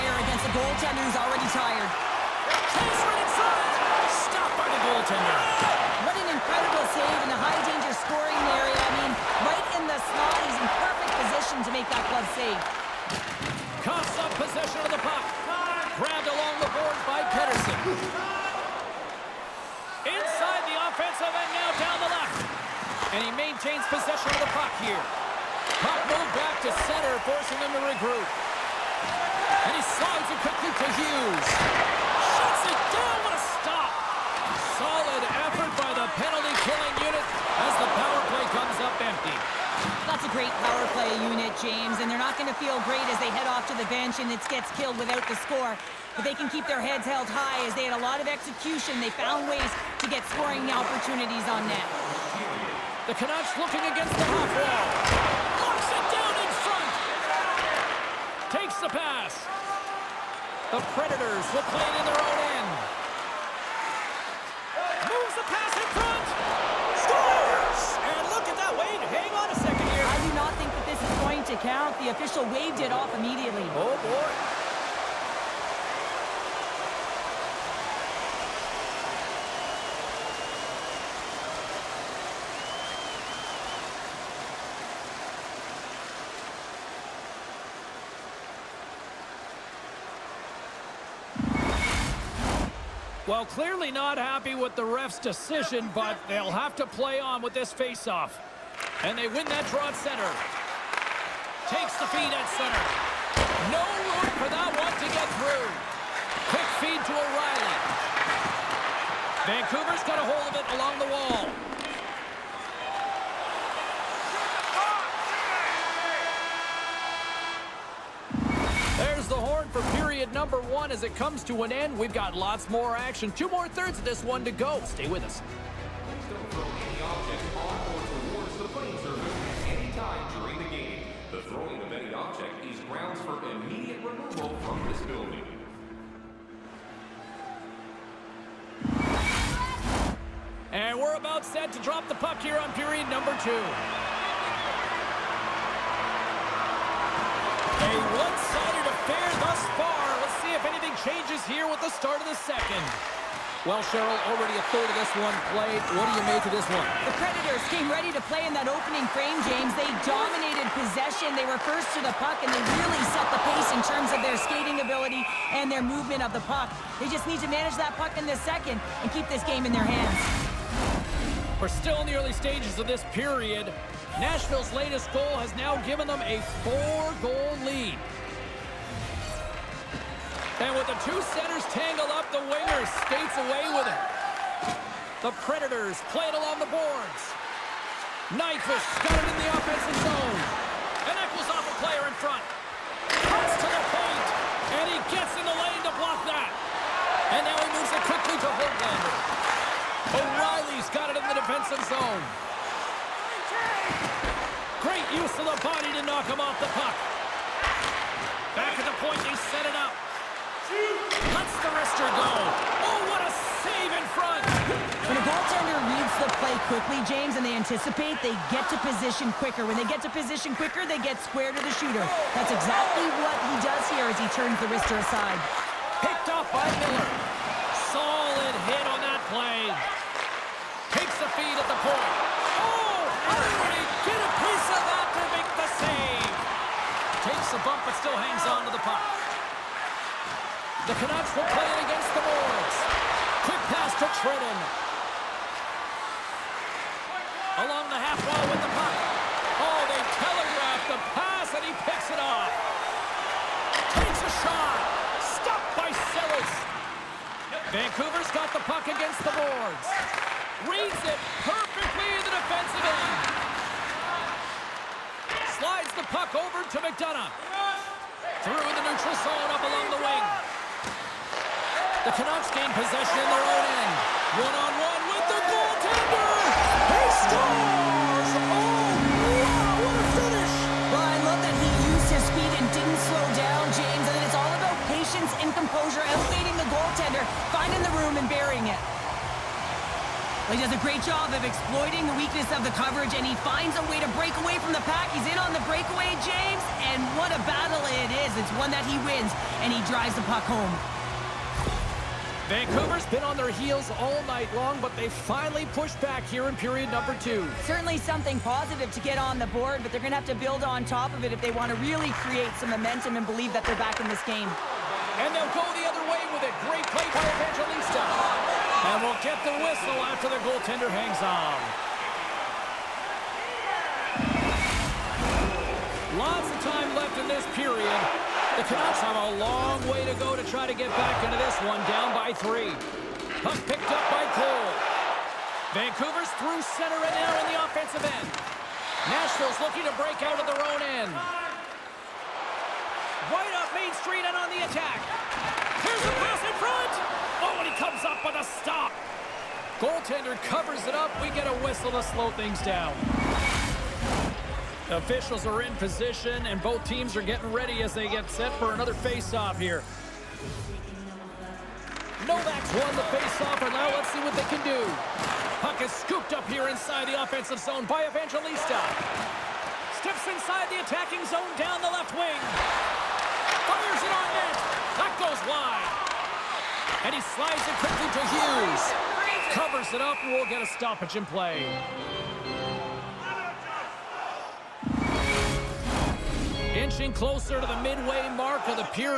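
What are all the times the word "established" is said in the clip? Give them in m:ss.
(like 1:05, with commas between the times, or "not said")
not said.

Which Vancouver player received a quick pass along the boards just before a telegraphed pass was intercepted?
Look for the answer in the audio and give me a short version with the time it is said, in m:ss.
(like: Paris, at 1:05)
Trenin, at 4:04.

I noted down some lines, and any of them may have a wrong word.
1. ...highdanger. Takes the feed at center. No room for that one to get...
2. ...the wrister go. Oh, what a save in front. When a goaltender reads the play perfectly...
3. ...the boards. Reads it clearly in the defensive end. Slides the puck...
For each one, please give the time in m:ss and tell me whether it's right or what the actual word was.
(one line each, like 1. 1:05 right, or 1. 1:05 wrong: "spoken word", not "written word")
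1. 1:39 wrong: "center", not "highdanger"
2. 3:31 wrong: "quickly", not "perfectly"
3. 4:19 wrong: "perfectly", not "clearly".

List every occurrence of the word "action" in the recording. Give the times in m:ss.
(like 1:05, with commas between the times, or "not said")
2:02.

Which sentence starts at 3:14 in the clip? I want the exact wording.
And he gets in the lane to block that.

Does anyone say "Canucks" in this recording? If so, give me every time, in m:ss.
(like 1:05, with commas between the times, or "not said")
0:53, 4:00, 4:32.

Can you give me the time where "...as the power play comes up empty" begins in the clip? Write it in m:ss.
0:37.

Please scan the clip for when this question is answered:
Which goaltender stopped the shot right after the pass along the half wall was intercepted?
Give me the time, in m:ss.
4:15.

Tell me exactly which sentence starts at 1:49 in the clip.
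Vancouver's got a hold of it along the wall.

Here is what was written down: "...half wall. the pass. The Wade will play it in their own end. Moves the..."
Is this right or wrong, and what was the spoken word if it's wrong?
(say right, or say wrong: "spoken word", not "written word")
wrong: "Predators", not "Wade".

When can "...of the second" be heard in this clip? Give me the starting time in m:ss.
2:32.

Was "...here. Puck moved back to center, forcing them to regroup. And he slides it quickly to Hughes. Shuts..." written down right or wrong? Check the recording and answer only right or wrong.
right.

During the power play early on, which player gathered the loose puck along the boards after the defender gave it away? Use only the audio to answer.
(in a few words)
Pettersson.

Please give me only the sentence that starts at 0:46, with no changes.
But they can keep their heads held high as they had a lot of execution.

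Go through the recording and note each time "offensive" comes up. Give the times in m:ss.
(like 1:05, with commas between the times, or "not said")
0:20, 3:09, 5:37, 6:07.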